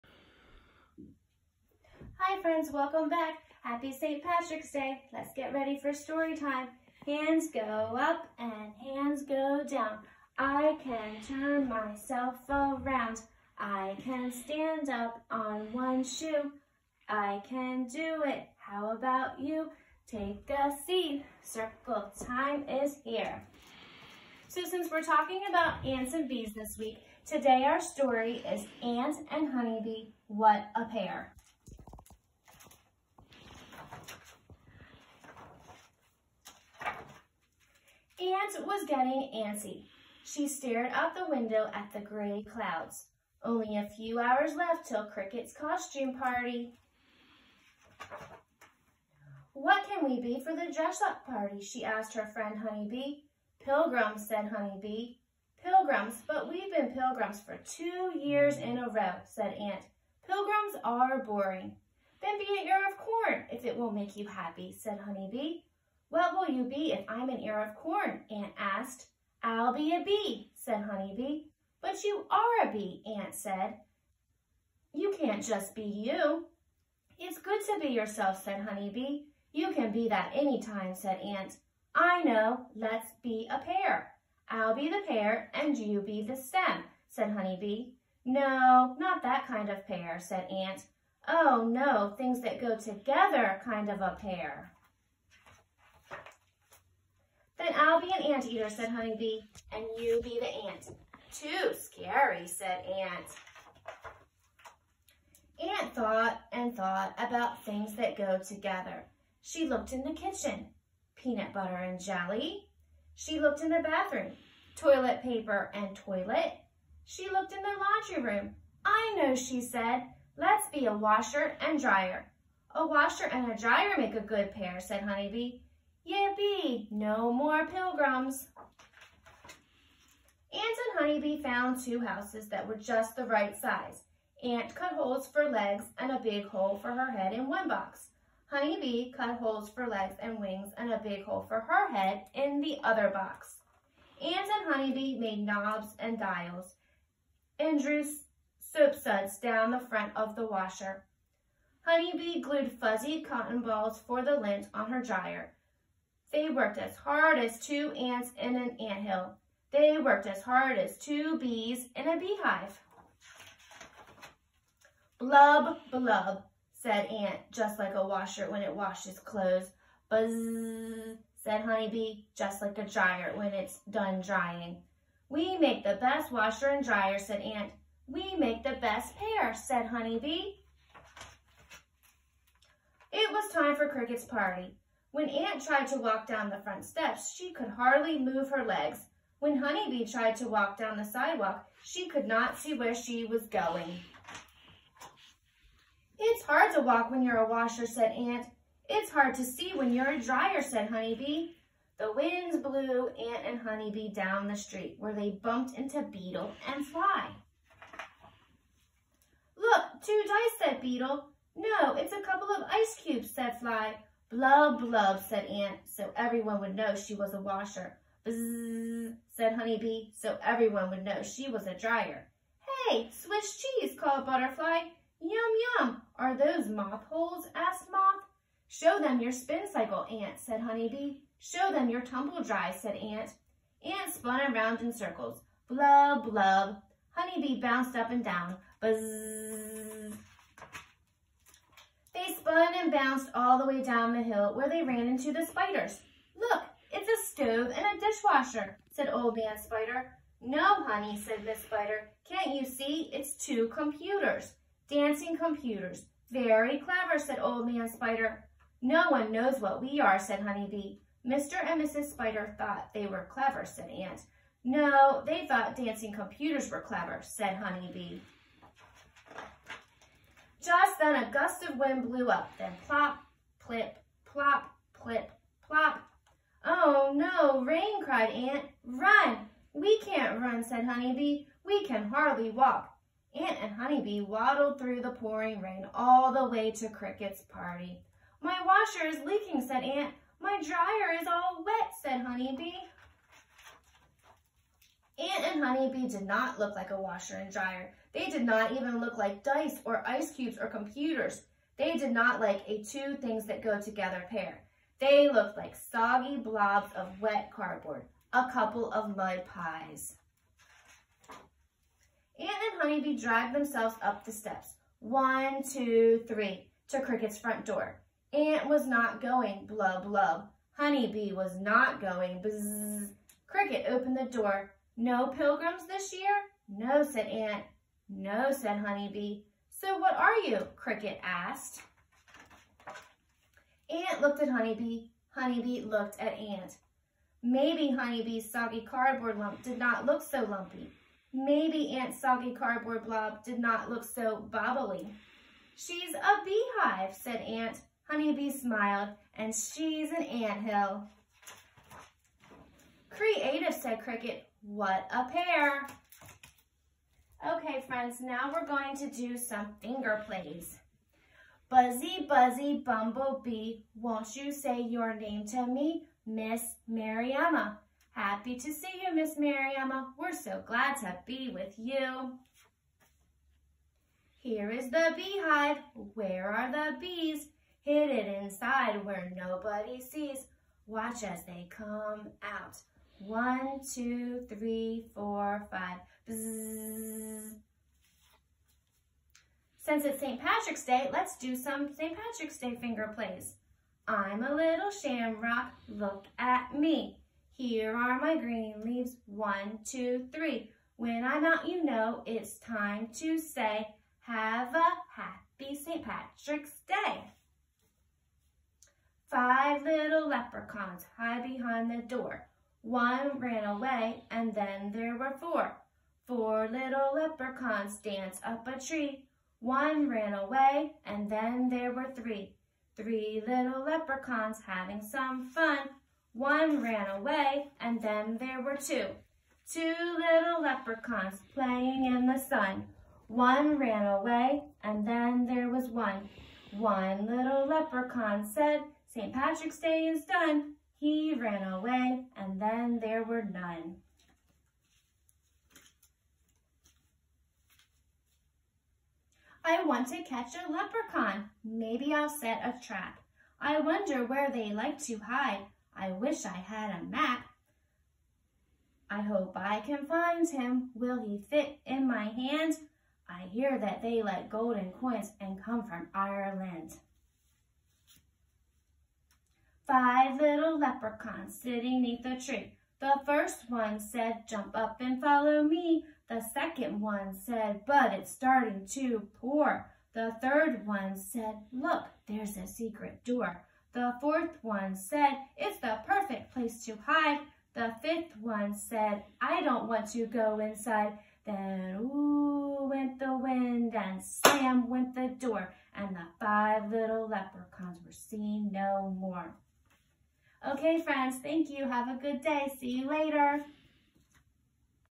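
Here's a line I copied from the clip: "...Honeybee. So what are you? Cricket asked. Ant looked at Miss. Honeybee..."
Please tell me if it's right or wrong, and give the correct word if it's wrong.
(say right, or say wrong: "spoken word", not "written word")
wrong: "Honeybee", not "Miss".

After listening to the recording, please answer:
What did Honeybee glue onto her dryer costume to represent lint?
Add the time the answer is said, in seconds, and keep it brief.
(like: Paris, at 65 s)
Fuzzy cotton balls, at 152 s.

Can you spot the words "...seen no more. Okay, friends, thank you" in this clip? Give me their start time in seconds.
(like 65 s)
498 s.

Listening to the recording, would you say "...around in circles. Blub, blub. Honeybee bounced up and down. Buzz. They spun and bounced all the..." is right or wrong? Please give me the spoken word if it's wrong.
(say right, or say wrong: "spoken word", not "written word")
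right.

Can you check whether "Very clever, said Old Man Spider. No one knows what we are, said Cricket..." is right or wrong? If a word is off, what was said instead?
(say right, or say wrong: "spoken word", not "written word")
wrong: "Honey", not "Cricket".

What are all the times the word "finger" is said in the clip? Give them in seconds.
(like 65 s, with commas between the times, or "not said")
359 s, 392 s.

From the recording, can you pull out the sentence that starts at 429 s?
Two little leprechauns playing in the sun.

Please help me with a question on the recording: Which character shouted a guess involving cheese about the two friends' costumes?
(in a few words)
Butterfly.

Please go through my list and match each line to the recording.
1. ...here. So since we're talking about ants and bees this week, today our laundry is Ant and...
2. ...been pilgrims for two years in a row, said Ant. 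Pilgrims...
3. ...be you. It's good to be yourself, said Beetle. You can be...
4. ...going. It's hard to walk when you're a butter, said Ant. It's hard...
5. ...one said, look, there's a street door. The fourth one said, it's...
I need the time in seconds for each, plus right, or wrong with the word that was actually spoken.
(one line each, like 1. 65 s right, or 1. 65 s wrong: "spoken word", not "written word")
1. 23 s wrong: "story", not "laundry"
2. 56 s right
3. 75 s wrong: "Honeybee", not "Beetle"
4. 193 s wrong: "washer", not "butter"
5. 480 s wrong: "secret", not "street".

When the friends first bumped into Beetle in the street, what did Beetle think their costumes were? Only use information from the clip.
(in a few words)
Two dice.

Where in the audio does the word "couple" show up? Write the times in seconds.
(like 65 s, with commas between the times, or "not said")
212 s, 308 s.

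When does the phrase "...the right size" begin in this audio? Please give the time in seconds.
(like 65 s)
133 s.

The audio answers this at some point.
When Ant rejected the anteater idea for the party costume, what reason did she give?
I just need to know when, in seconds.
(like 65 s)
101 s.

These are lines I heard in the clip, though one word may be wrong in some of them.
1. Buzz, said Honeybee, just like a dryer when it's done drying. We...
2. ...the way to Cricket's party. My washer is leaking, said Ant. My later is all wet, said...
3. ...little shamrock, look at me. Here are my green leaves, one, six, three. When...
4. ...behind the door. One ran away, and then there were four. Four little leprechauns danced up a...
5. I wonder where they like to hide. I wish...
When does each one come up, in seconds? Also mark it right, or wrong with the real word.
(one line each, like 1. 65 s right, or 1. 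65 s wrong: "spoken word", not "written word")
1. 170 s right
2. 286 s wrong: "dryer", not "later"
3. 394 s wrong: "two", not "six"
4. 411 s right
5. 453 s right.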